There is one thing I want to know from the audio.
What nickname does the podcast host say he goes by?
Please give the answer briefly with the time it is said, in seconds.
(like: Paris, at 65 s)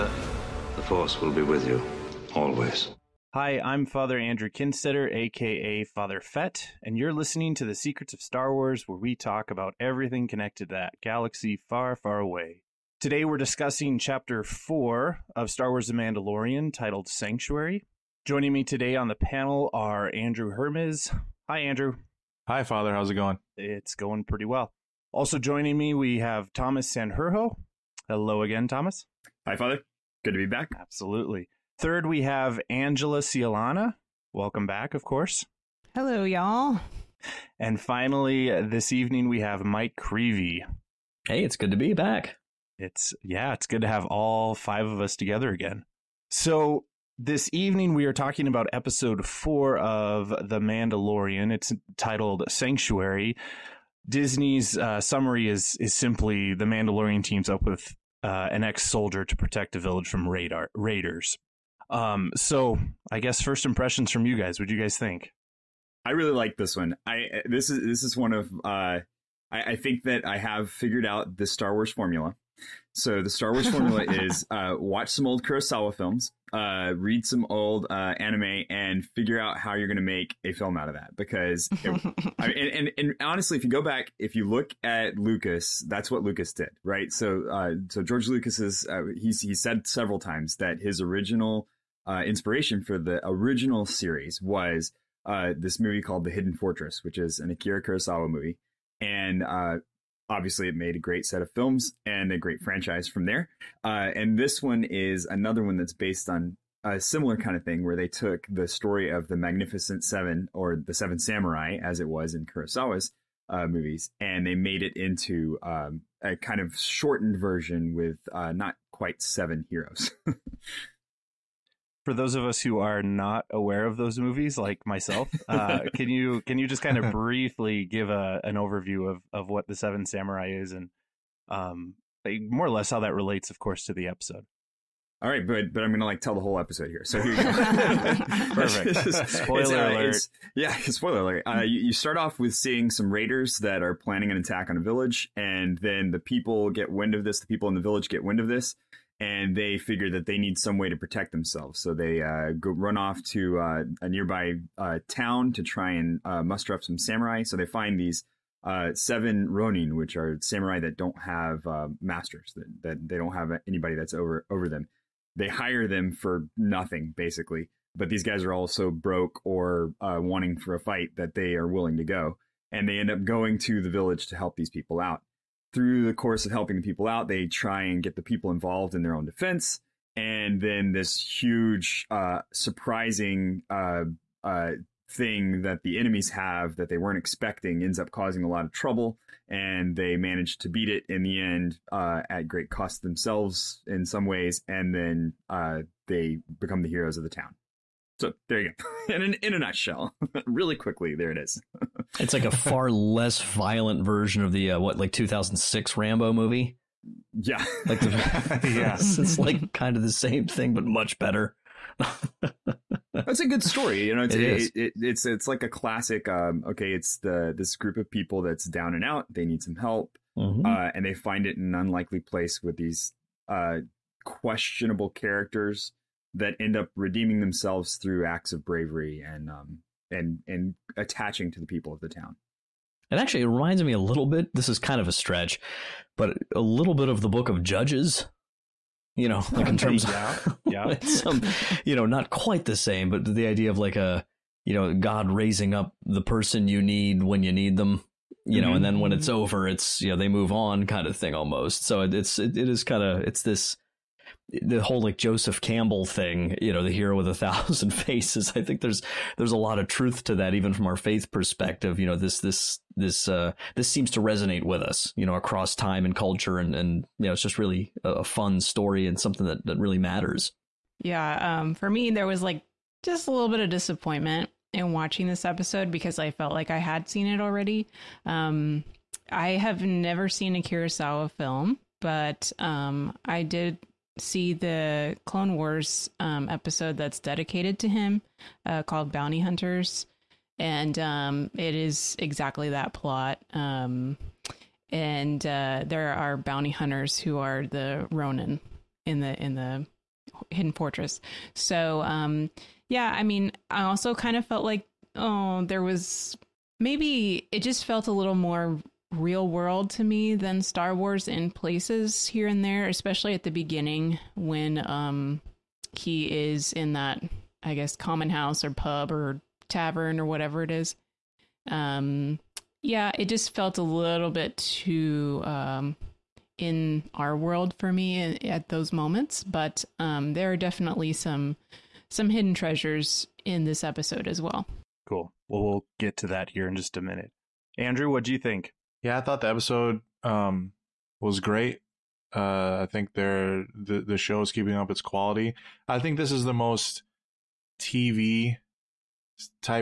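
Father Fett, at 5 s.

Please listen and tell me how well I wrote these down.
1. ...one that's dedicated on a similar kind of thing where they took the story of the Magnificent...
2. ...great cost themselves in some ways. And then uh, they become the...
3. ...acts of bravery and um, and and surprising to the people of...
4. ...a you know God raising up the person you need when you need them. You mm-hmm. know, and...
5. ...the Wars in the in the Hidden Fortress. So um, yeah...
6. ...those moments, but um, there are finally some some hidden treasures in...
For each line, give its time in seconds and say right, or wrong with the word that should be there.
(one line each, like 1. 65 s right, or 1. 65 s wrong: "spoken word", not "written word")
1. 105 s wrong: "based", not "dedicated"
2. 192 s right
3. 228 s wrong: "attaching", not "surprising"
4. 243 s right
5. 297 s wrong: "Ronin", not "Wars"
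6. 328 s wrong: "definitely", not "finally".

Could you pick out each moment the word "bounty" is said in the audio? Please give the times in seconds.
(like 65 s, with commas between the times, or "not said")
289 s, 296 s.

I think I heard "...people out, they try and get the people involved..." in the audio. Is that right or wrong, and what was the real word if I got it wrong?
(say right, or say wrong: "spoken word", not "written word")
right.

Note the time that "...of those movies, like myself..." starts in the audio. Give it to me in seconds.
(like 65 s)
123 s.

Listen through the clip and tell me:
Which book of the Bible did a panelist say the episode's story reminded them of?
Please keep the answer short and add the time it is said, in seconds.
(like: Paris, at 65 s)
Book of Judges, at 237 s.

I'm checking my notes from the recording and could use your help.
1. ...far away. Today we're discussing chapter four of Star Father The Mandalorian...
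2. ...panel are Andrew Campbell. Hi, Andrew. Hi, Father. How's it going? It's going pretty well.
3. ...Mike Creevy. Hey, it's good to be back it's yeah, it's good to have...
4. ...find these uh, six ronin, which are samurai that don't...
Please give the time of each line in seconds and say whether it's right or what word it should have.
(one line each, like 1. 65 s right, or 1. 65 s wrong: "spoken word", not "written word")
1. 11 s wrong: "Wars", not "Father"
2. 19 s wrong: "Hermes", not "Campbell"
3. 39 s right
4. 157 s wrong: "seven", not "six".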